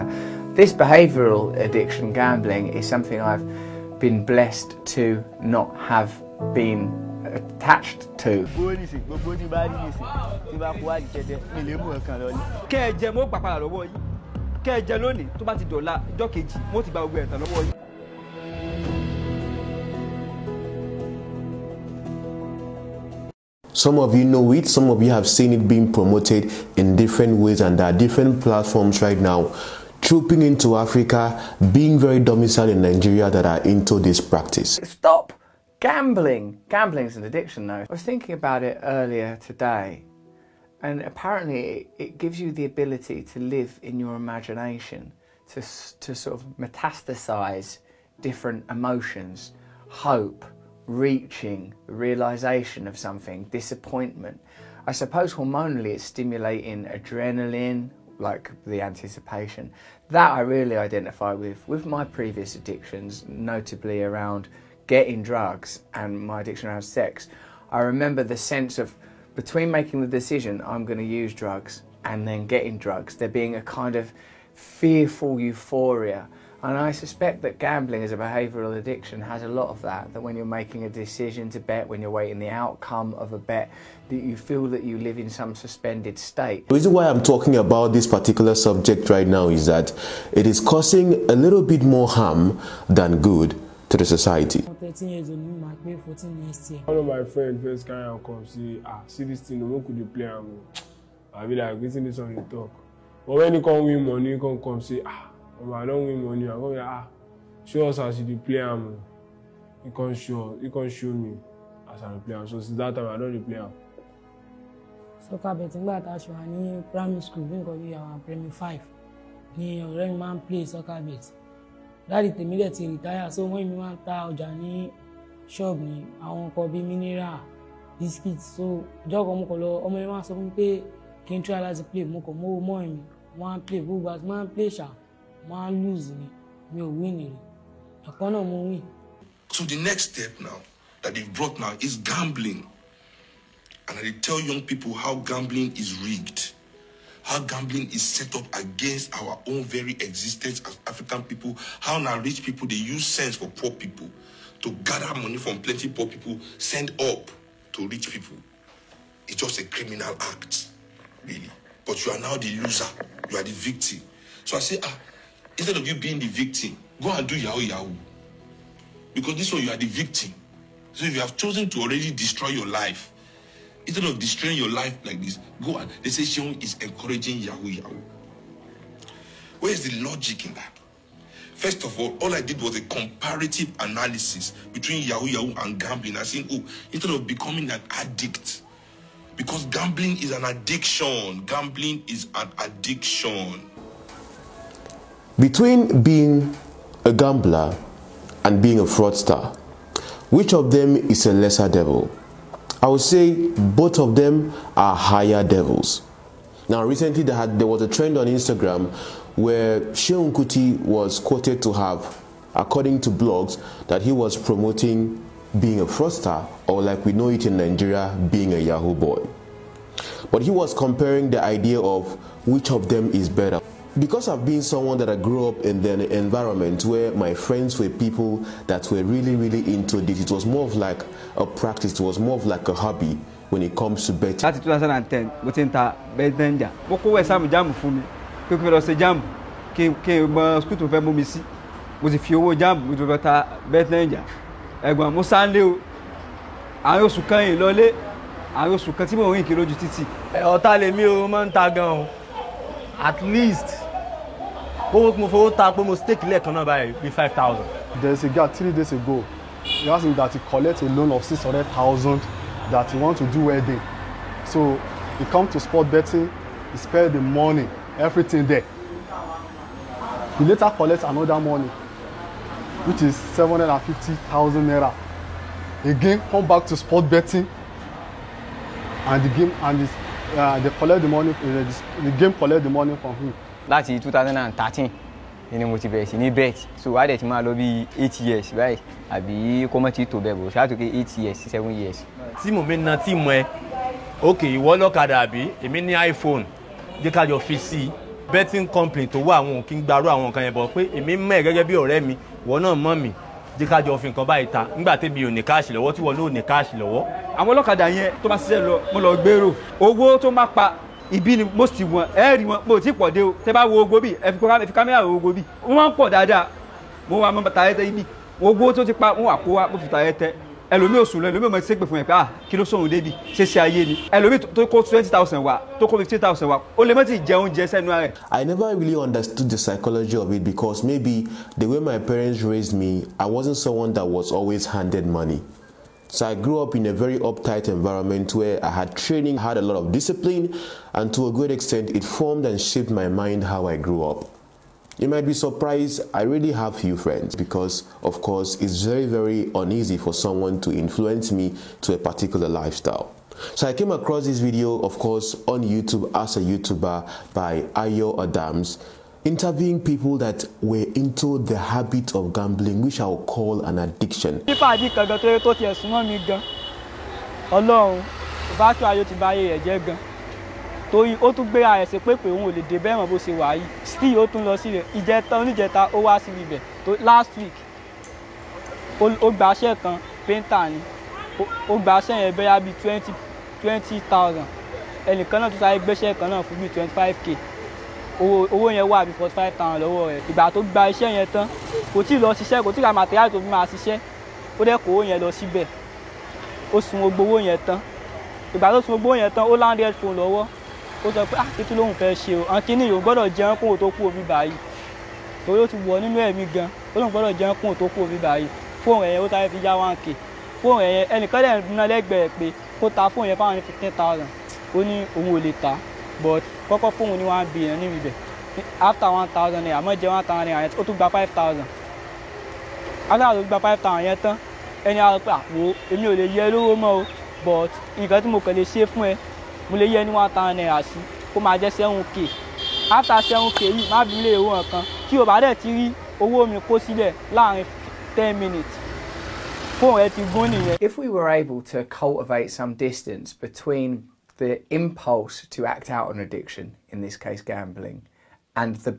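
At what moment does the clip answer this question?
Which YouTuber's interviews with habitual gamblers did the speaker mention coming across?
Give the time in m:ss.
5:57.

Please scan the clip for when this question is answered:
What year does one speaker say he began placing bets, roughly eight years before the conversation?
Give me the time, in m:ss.
4:43.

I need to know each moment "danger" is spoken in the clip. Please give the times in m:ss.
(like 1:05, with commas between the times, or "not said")
3:56, 4:03.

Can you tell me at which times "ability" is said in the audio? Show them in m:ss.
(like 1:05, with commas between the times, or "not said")
0:42.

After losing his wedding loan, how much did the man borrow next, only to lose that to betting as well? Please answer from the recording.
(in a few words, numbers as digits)
750,000 naira.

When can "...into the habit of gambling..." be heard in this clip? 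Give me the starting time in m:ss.
6:00.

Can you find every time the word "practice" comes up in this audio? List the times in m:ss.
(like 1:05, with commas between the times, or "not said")
0:34, 3:51.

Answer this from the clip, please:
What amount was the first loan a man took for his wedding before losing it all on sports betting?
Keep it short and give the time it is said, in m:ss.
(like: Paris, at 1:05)
600,000, at 4:21.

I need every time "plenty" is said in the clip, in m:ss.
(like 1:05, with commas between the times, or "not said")
2:35.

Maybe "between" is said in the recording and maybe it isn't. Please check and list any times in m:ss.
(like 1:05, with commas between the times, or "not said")
1:09, 3:04, 3:15, 7:23.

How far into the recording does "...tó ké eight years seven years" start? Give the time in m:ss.
4:50.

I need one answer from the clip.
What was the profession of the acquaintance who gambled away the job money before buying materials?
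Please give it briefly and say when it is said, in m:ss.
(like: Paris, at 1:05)
painter, at 6:20.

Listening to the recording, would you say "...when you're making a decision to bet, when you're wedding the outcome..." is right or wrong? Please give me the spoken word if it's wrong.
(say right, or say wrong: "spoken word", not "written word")
wrong: "waiting", not "wedding".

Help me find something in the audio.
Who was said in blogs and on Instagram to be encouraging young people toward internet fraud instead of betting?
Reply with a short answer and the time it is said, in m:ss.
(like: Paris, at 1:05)
Seun Kuti, at 3:29.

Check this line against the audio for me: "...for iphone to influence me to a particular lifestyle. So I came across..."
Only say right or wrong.
wrong.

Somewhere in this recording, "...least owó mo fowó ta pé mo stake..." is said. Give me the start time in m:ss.
4:13.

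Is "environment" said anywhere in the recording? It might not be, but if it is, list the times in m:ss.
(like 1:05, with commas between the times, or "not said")
3:46, 5:37.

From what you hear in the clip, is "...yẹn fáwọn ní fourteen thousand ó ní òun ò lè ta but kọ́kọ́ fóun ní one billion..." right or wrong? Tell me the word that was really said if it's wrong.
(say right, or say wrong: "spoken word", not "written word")
wrong: "fifteen", not "fourteen".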